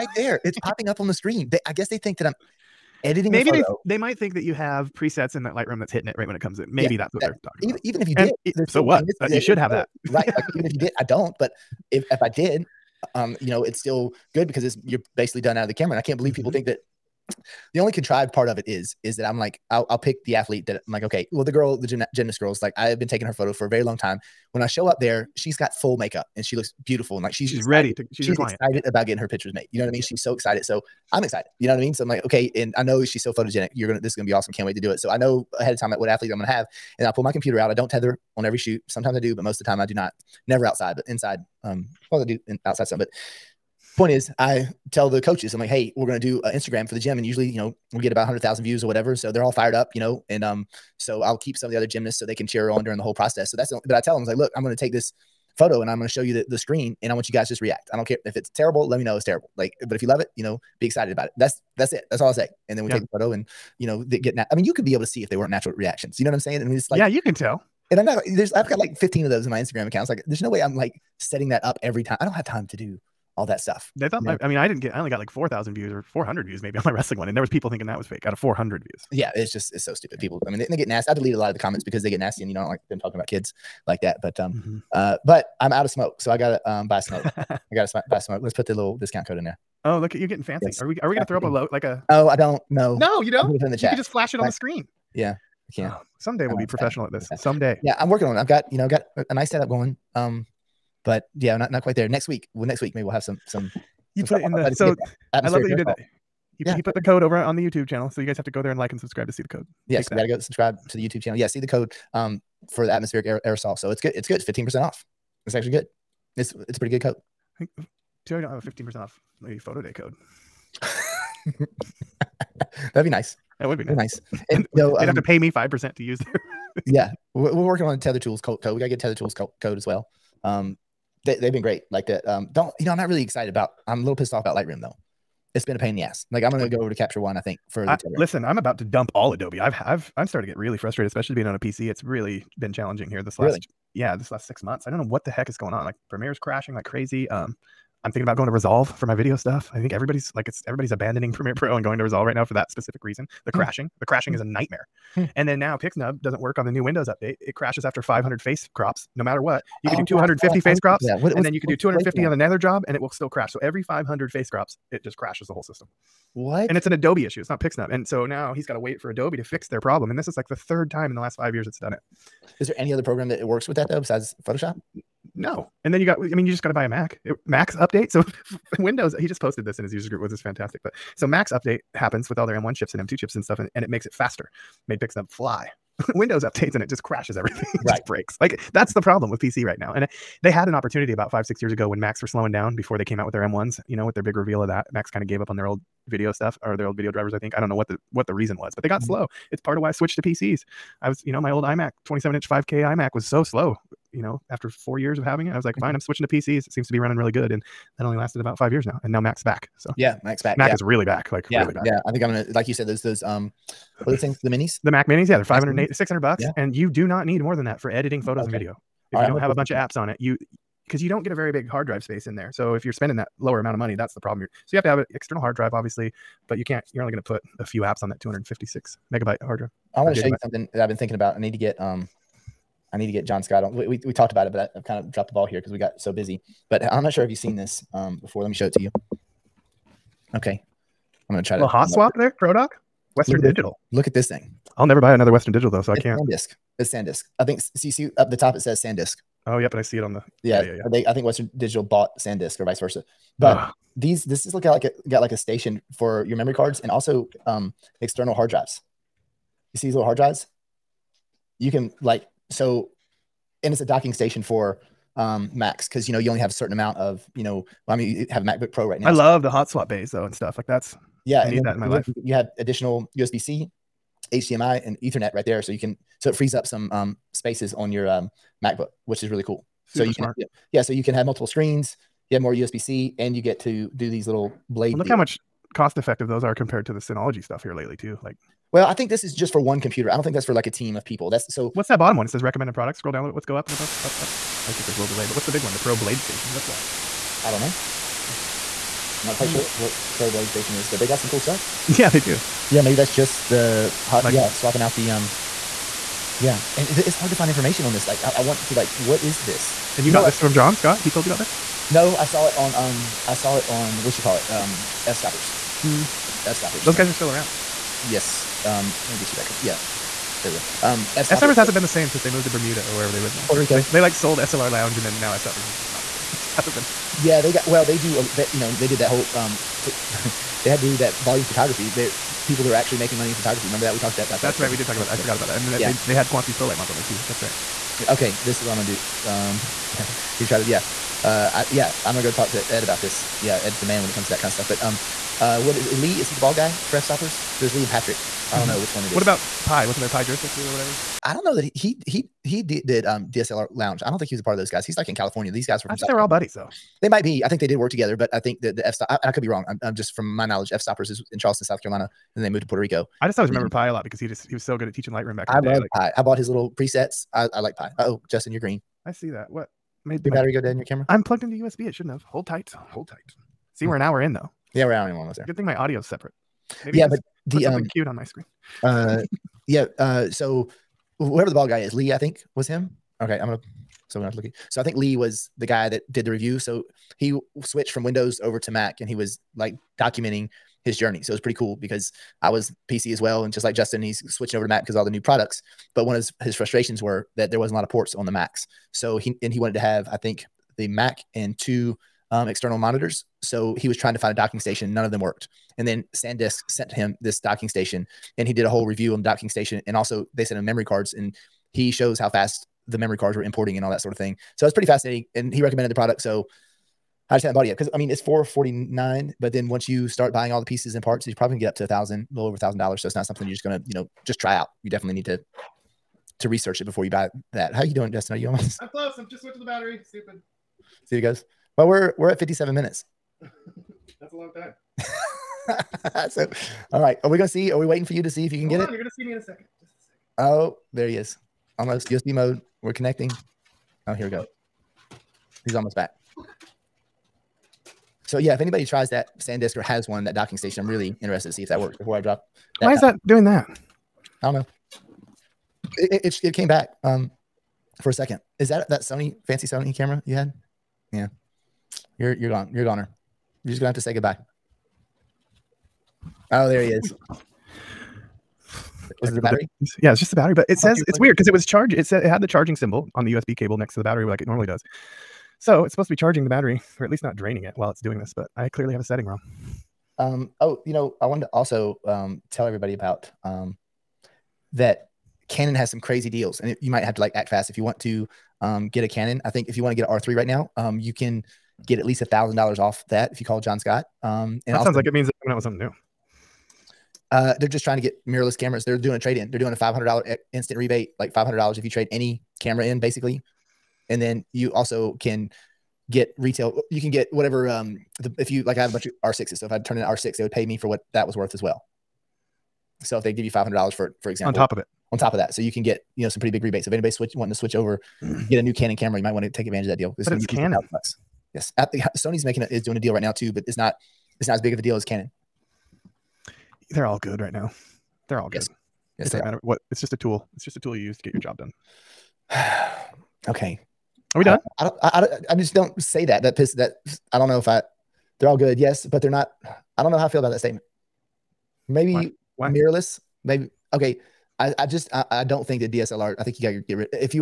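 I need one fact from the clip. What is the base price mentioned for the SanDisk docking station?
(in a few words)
$449.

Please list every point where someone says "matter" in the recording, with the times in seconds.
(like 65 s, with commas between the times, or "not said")
159 s, 529 s.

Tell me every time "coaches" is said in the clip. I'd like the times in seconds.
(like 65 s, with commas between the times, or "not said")
45 s.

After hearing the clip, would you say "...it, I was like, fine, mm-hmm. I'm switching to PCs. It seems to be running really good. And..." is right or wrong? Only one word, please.
right.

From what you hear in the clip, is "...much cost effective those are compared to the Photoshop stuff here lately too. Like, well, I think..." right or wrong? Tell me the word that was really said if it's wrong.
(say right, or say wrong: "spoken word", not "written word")
wrong: "Synology", not "Photoshop".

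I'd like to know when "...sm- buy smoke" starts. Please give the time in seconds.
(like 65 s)
87 s.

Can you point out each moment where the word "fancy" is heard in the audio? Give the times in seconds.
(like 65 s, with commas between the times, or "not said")
90 s, 459 s.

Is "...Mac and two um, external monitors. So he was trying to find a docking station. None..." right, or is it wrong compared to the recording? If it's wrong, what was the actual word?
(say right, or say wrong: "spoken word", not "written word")
right.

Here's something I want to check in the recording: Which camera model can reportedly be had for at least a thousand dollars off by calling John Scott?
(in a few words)
Canon R3.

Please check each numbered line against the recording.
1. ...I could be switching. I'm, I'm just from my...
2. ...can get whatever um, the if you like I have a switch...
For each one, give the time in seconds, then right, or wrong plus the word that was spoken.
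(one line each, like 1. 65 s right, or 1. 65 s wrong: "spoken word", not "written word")
1. 359 s wrong: "wrong", not "switching"
2. 507 s wrong: "bunch", not "switch".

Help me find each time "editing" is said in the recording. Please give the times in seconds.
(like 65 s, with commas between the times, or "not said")
3 s, 217 s.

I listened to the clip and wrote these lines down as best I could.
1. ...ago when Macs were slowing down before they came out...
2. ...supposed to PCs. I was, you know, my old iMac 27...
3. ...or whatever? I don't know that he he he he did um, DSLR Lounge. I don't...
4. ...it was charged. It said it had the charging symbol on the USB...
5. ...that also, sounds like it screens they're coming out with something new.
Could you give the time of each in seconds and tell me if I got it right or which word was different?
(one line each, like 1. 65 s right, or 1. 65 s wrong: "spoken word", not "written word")
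1. 191 s right
2. 199 s wrong: "switched", not "supposed"
3. 350 s right
4. 471 s right
5. 494 s wrong: "means", not "screens".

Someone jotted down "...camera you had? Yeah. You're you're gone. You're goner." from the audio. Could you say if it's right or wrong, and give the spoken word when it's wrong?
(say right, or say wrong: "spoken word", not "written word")
right.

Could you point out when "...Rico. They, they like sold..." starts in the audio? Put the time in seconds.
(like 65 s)
323 s.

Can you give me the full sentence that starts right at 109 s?
Yes, you got to go subscribe to the YouTube channel.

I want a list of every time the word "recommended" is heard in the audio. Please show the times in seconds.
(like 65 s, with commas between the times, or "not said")
292 s, 415 s.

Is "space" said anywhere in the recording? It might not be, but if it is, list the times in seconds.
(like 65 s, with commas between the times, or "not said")
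222 s, 277 s.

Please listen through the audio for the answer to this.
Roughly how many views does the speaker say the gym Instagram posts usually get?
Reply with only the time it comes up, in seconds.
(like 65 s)
48 s.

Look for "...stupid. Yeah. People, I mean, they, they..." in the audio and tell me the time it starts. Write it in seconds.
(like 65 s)
79 s.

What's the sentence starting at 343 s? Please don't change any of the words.
Yeah, Ed's the man when it comes to that kind of stuff.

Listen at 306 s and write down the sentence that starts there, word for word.
Yeah, and it's hard to find information on this.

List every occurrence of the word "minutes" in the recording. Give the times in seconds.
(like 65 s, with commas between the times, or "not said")
432 s.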